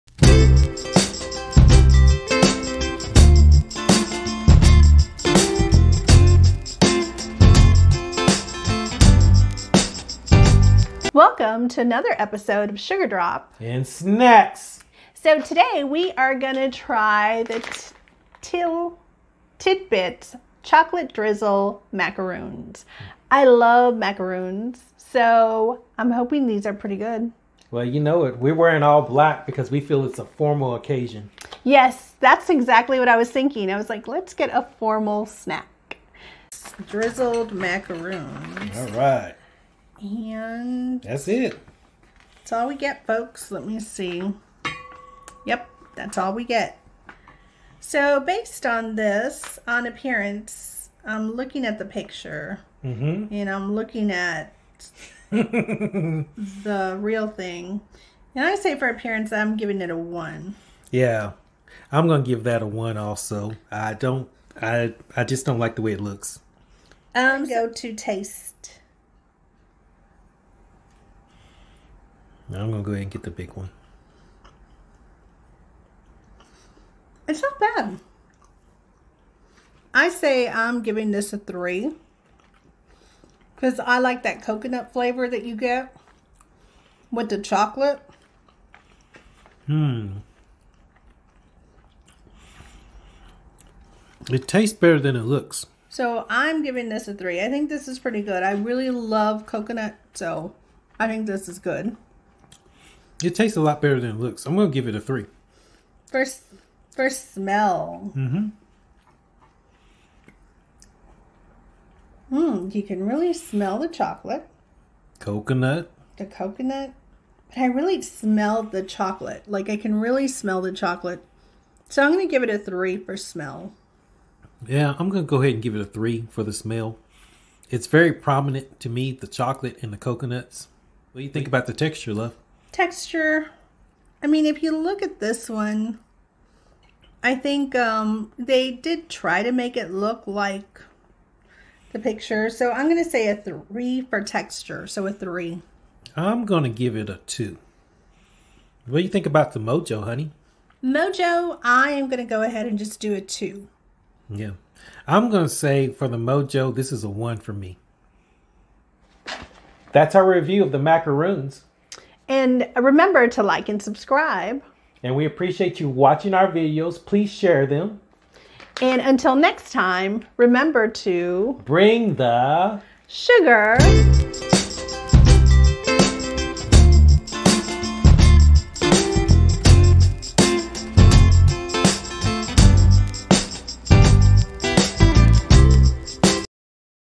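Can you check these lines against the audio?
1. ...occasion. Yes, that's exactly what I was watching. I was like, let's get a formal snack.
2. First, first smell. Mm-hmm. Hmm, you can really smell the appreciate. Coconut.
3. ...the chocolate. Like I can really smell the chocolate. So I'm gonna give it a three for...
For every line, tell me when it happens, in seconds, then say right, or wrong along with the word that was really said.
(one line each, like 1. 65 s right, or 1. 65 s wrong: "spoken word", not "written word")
1. 30 s wrong: "thinking", not "watching"
2. 106 s wrong: "chocolate", not "appreciate"
3. 118 s right.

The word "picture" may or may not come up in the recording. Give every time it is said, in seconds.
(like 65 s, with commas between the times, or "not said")
51 s, 141 s.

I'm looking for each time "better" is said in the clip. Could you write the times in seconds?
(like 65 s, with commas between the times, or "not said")
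94 s, 103 s.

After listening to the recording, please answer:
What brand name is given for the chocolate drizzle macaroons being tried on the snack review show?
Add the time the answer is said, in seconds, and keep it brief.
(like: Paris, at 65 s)
Till Tidbits, at 18 s.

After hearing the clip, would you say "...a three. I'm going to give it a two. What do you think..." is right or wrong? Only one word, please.
right.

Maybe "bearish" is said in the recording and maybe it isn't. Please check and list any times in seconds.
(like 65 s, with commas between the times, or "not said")
not said.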